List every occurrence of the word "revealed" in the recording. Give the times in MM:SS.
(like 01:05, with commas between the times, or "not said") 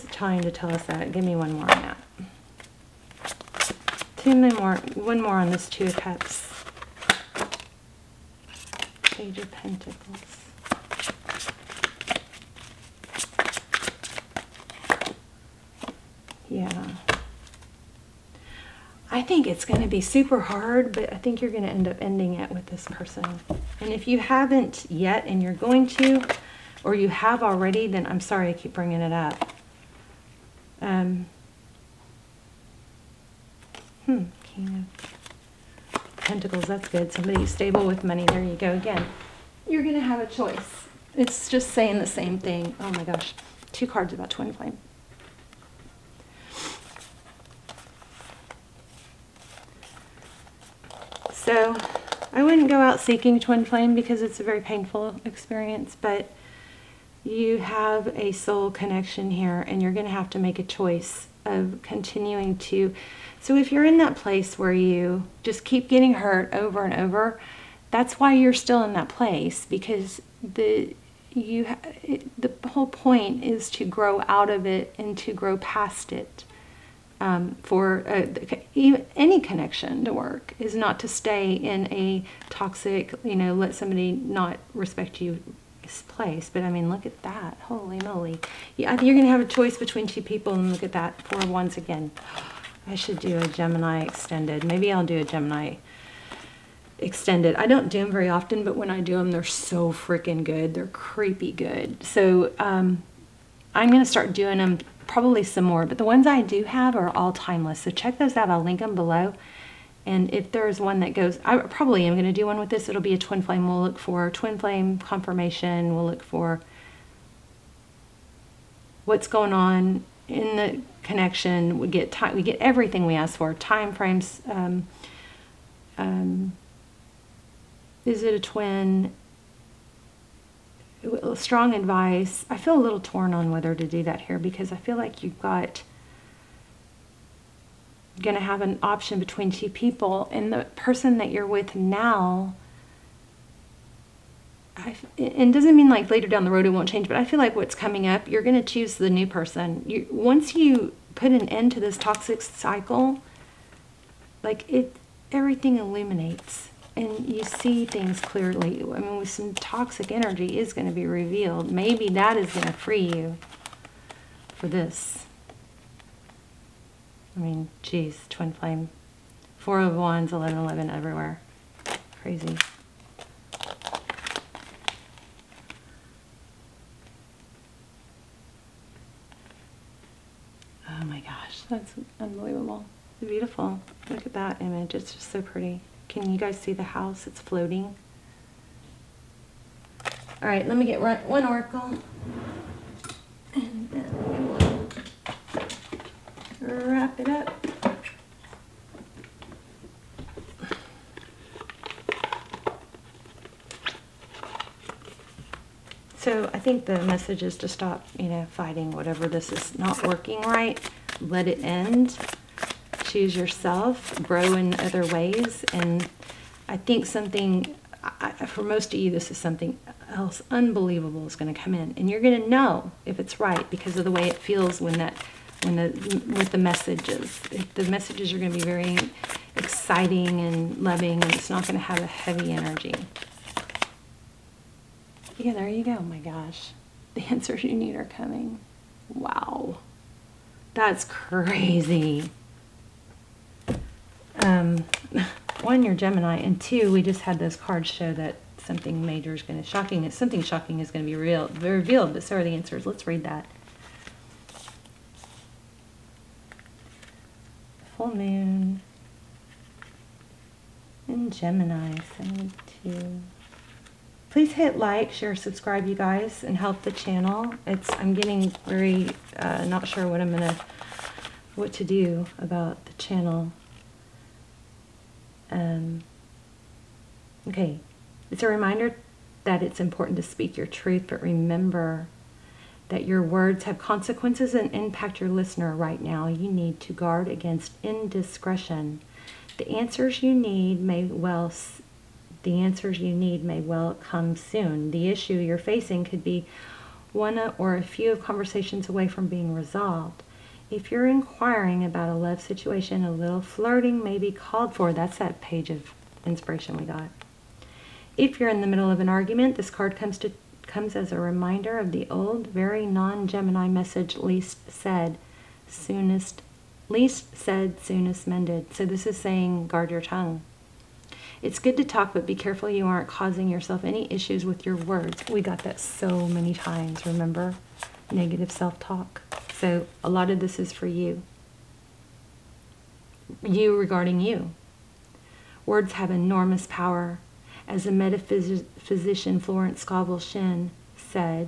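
02:41, 04:11.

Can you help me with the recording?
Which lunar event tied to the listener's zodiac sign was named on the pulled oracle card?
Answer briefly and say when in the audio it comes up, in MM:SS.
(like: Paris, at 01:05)
Full moon in Gemini, at 04:17.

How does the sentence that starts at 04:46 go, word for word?
You need to guard against indiscretion.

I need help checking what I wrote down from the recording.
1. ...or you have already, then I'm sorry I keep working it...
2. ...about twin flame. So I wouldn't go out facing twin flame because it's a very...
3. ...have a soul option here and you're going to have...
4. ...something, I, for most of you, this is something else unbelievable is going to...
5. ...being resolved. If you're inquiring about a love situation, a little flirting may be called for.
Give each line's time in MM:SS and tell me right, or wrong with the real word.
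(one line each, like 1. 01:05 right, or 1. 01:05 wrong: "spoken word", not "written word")
1. 00:26 wrong: "bringing", not "working"
2. 00:44 wrong: "seeking", not "facing"
3. 00:57 wrong: "connection", not "option"
4. 03:37 right
5. 04:59 right.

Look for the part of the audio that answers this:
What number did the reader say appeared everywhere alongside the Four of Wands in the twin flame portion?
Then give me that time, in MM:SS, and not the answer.
02:50.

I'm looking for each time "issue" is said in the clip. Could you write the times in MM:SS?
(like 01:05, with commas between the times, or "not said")
04:55, 05:24.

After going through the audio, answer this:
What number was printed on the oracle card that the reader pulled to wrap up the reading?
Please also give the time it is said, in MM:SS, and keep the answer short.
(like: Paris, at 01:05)
72, at 04:22.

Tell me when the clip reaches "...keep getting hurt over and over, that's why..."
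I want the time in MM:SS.
01:05.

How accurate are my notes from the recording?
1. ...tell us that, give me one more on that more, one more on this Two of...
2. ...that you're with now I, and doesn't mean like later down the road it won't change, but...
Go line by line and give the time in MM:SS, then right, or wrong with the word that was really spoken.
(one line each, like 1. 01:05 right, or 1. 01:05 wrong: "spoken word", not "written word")
1. 00:00 right
2. 02:21 right.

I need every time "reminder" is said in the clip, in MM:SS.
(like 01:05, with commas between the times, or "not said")
04:38, 05:11.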